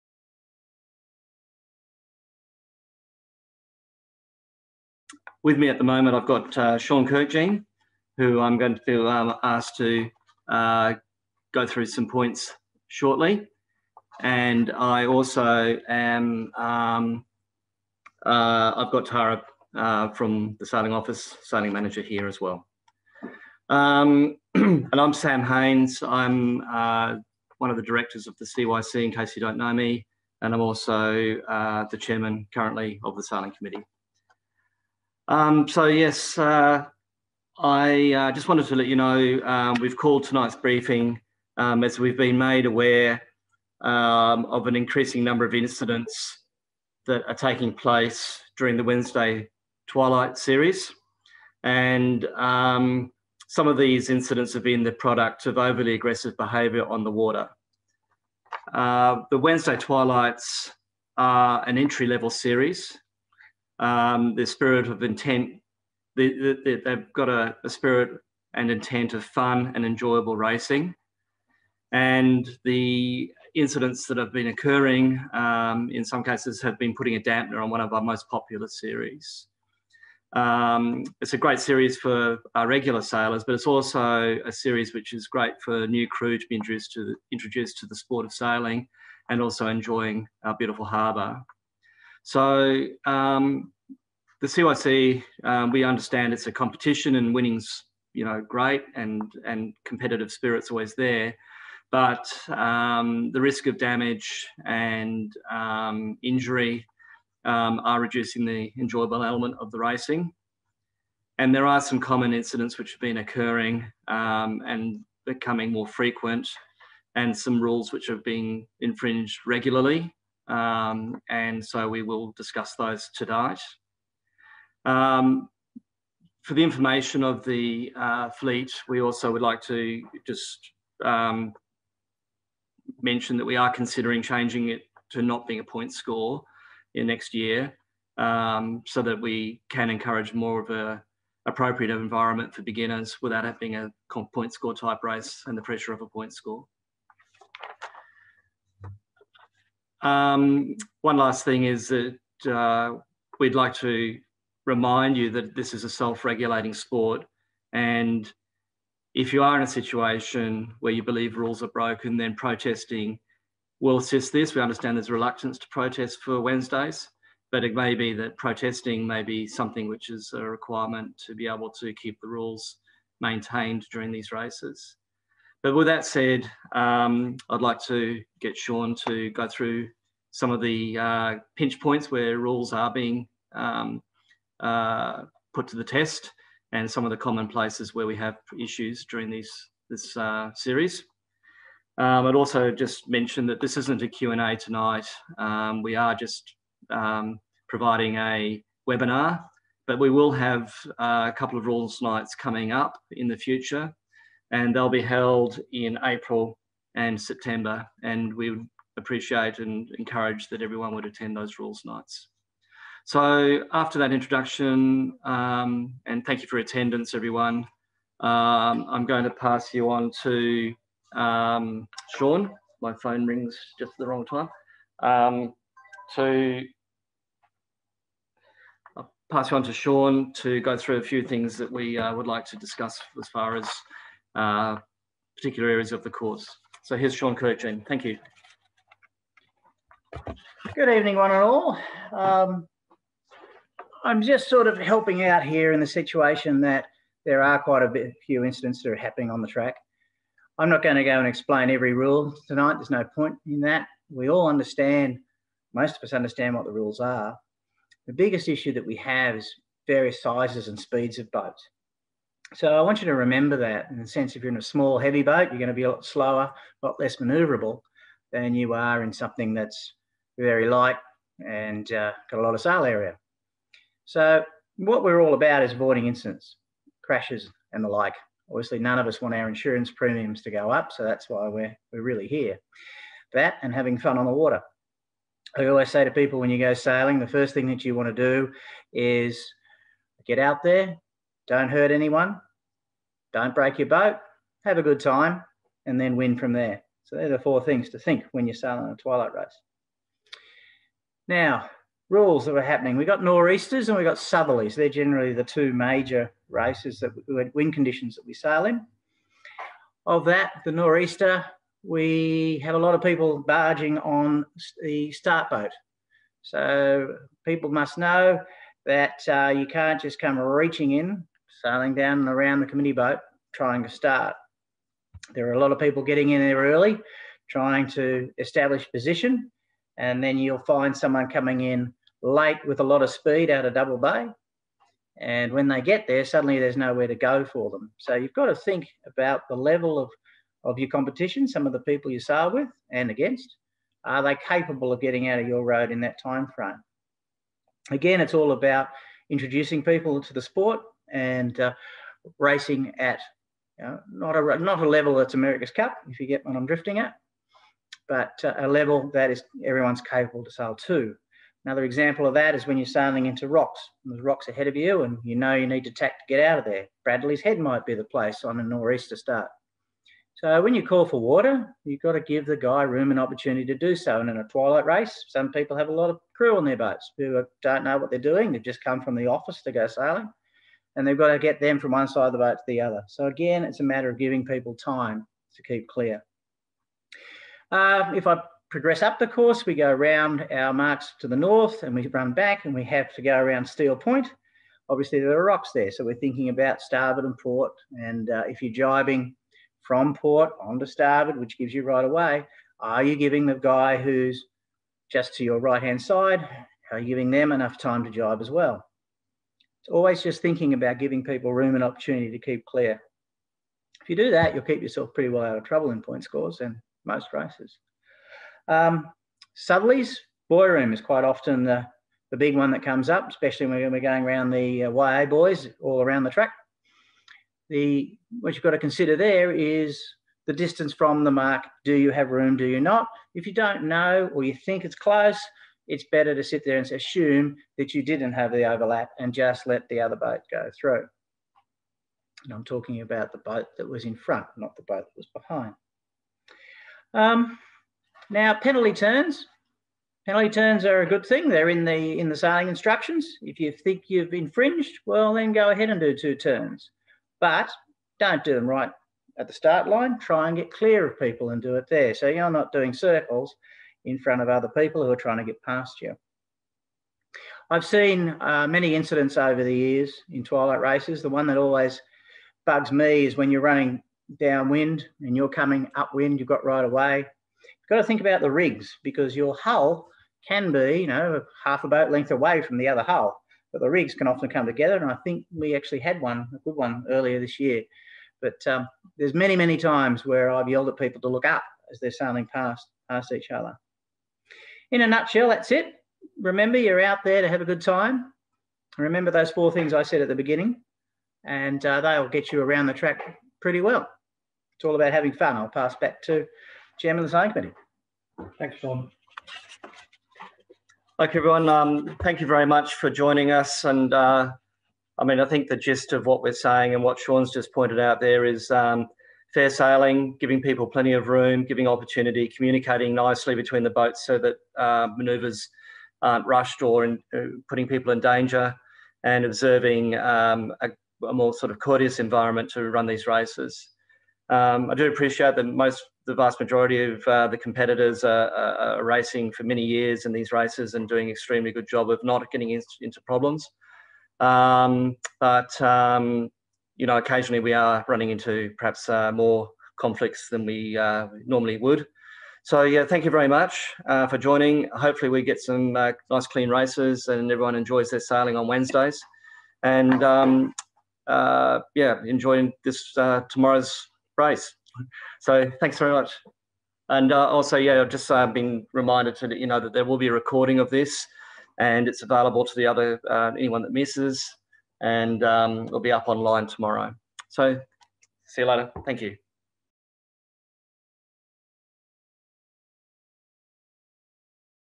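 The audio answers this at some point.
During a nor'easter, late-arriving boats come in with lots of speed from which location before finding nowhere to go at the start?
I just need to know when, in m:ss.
5:33.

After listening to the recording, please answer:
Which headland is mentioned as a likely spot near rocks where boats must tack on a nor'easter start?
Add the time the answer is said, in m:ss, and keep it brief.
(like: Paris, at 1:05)
Bradley's Head, at 6:07.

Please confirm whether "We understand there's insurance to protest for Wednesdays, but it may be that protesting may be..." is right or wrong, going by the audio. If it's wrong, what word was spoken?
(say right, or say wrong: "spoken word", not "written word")
wrong: "reluctance", not "insurance".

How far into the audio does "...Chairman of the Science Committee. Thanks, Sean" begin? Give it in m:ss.
8:26.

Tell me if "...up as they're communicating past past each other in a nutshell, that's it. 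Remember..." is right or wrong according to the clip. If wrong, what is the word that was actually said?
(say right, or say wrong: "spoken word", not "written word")
wrong: "sailing", not "communicating".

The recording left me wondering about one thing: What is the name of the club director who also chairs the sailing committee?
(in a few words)
Sam Haynes.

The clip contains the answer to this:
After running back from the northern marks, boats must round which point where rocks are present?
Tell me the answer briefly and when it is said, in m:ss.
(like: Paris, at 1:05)
Steele Point, at 6:33.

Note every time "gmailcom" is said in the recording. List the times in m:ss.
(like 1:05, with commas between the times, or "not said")
not said.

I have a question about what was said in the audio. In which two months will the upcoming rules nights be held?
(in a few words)
April and September.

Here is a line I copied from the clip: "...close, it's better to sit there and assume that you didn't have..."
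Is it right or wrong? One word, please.
right.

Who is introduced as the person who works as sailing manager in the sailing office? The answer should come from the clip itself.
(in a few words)
Tara.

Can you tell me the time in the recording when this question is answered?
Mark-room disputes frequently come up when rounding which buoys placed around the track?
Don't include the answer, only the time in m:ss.
7:04.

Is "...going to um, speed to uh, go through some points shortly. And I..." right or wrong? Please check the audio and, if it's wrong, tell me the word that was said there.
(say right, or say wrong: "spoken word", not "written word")
wrong: "asked", not "speed".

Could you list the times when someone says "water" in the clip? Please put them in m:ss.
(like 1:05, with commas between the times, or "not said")
0:57, 4:44, 6:11.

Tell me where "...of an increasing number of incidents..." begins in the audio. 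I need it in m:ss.
0:44.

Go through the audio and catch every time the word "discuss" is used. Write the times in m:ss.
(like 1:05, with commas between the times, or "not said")
2:02, 3:52.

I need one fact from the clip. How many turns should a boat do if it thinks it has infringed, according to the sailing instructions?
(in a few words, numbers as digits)
2.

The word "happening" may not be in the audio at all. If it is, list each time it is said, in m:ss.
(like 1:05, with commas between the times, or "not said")
4:08, 5:02.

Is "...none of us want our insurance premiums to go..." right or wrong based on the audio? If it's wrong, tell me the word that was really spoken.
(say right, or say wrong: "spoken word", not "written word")
right.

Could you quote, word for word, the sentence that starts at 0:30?
And I'm also uh, the chairman currently of the sailing committee.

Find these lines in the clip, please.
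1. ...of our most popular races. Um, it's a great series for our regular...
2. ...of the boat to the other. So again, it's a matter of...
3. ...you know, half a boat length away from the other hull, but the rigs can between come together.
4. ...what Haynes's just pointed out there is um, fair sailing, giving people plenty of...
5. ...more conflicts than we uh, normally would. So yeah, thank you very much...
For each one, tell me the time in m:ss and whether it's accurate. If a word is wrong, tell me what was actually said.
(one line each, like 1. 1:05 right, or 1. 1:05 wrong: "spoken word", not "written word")
1. 1:17 wrong: "series", not "races"
2. 6:22 right
3. 8:01 wrong: "often", not "between"
4. 8:37 wrong: "Sean", not "Haynes"
5. 9:09 right.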